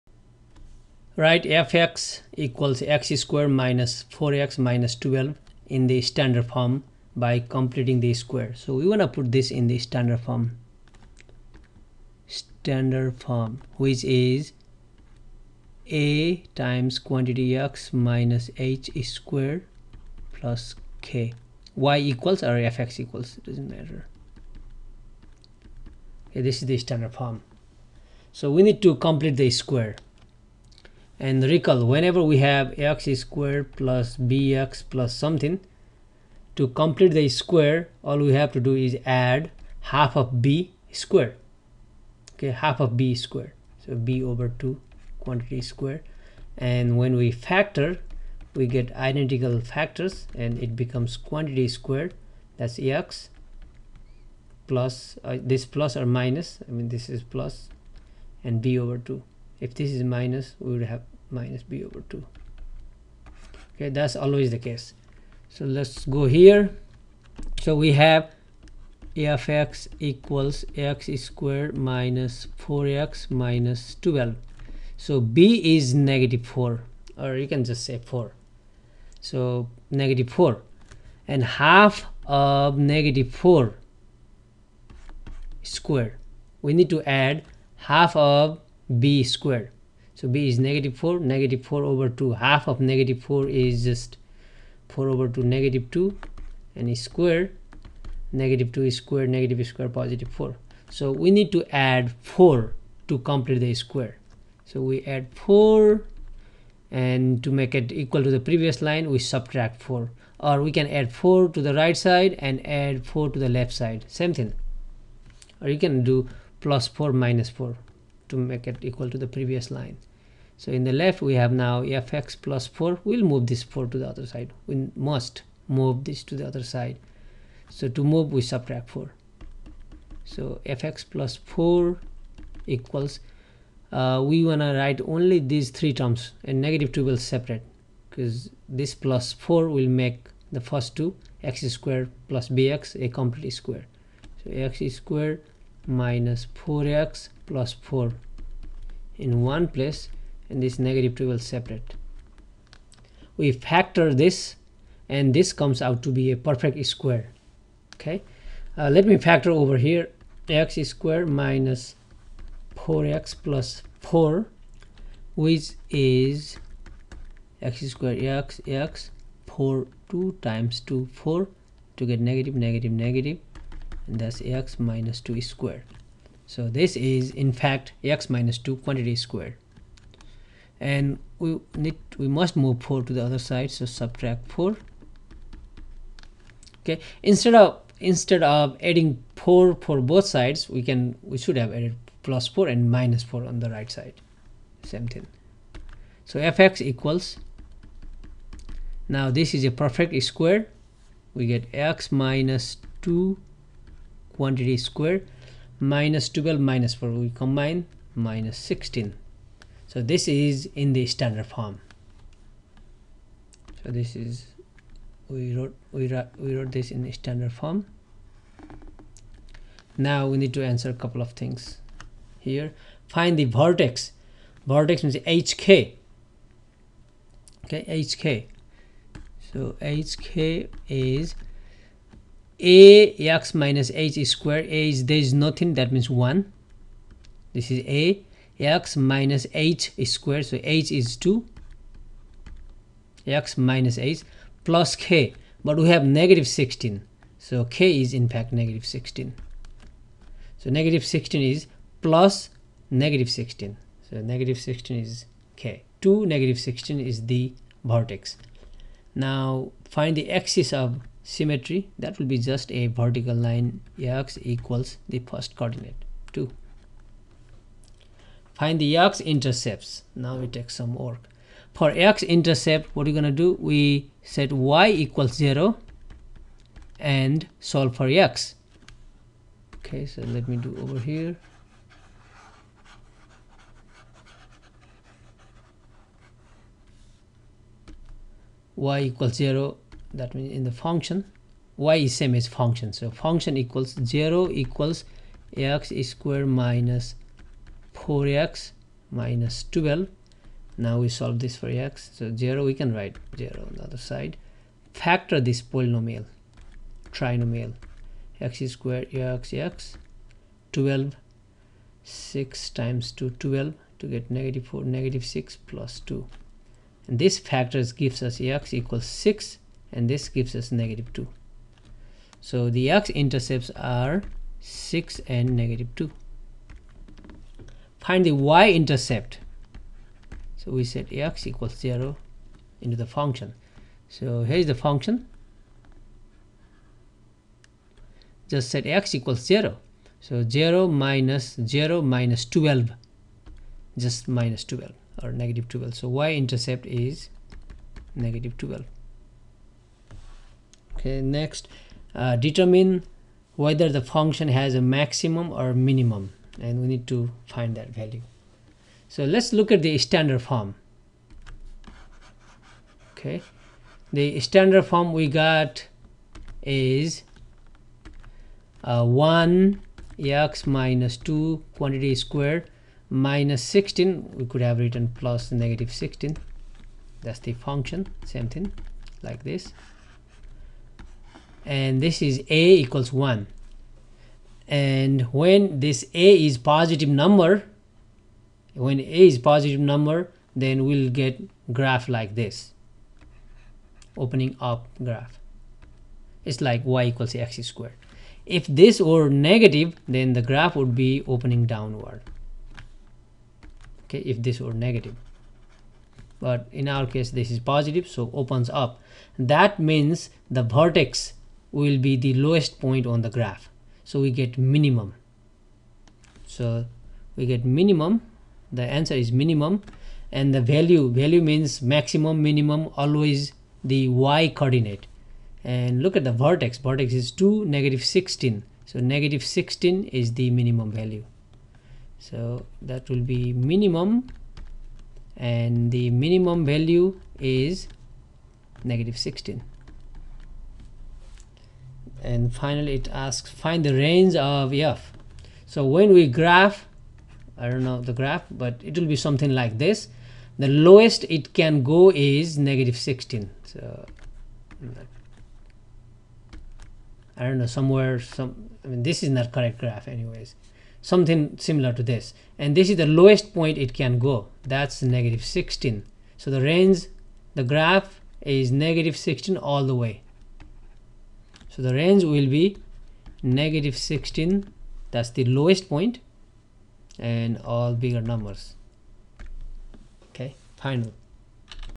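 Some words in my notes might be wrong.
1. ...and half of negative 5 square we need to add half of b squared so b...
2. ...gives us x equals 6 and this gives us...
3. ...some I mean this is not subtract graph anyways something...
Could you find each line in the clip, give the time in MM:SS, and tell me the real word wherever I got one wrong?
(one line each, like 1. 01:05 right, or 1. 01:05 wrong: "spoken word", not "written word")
1. 01:21 wrong: "4", not "5"
2. 05:17 right
3. 07:38 wrong: "correct", not "subtract".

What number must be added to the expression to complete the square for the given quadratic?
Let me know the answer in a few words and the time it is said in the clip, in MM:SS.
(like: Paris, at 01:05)
4, at 01:41.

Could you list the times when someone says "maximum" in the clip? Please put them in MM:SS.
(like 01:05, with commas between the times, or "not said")
05:54, 07:01.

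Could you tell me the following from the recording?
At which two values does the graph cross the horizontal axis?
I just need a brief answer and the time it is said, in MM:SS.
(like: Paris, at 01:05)
6 and -2, at 05:24.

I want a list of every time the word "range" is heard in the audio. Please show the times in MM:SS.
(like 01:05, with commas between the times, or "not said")
07:23, 07:46, 07:51.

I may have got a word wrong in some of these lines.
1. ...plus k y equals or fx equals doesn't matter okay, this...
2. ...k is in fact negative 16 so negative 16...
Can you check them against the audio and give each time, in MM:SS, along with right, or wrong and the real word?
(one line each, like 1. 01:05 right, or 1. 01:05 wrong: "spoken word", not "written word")
1. 00:20 right
2. 04:07 right.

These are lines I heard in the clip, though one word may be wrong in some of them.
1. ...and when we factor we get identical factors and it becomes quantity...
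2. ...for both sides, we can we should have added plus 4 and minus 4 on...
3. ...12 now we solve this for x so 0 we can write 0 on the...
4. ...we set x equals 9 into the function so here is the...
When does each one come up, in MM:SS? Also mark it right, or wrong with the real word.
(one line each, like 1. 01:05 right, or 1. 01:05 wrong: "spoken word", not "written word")
1. 00:46 right
2. 03:09 right
3. 04:59 right
4. 05:30 wrong: "0", not "9".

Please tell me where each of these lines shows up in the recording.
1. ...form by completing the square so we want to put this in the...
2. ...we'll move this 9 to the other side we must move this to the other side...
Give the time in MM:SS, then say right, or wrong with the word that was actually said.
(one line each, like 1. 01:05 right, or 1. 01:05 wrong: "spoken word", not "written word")
1. 00:06 right
2. 02:03 wrong: "4", not "9".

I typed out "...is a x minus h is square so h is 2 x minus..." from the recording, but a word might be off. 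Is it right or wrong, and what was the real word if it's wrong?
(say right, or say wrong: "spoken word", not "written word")
right.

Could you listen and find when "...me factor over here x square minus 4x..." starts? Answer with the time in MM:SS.
02:39.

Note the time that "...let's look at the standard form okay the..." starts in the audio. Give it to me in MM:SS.
05:59.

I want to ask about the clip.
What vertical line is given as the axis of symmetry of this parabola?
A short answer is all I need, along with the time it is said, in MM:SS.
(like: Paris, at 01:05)
x = 2, at 04:24.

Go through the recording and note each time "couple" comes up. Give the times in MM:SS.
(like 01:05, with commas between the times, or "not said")
03:40.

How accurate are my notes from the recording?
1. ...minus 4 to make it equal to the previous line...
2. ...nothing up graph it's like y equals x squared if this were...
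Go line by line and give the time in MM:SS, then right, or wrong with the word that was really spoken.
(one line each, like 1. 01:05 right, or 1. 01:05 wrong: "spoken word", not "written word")
1. 01:57 right
2. 06:34 wrong: "opening", not "nothing".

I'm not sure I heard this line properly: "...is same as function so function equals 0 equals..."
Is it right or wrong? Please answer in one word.
right.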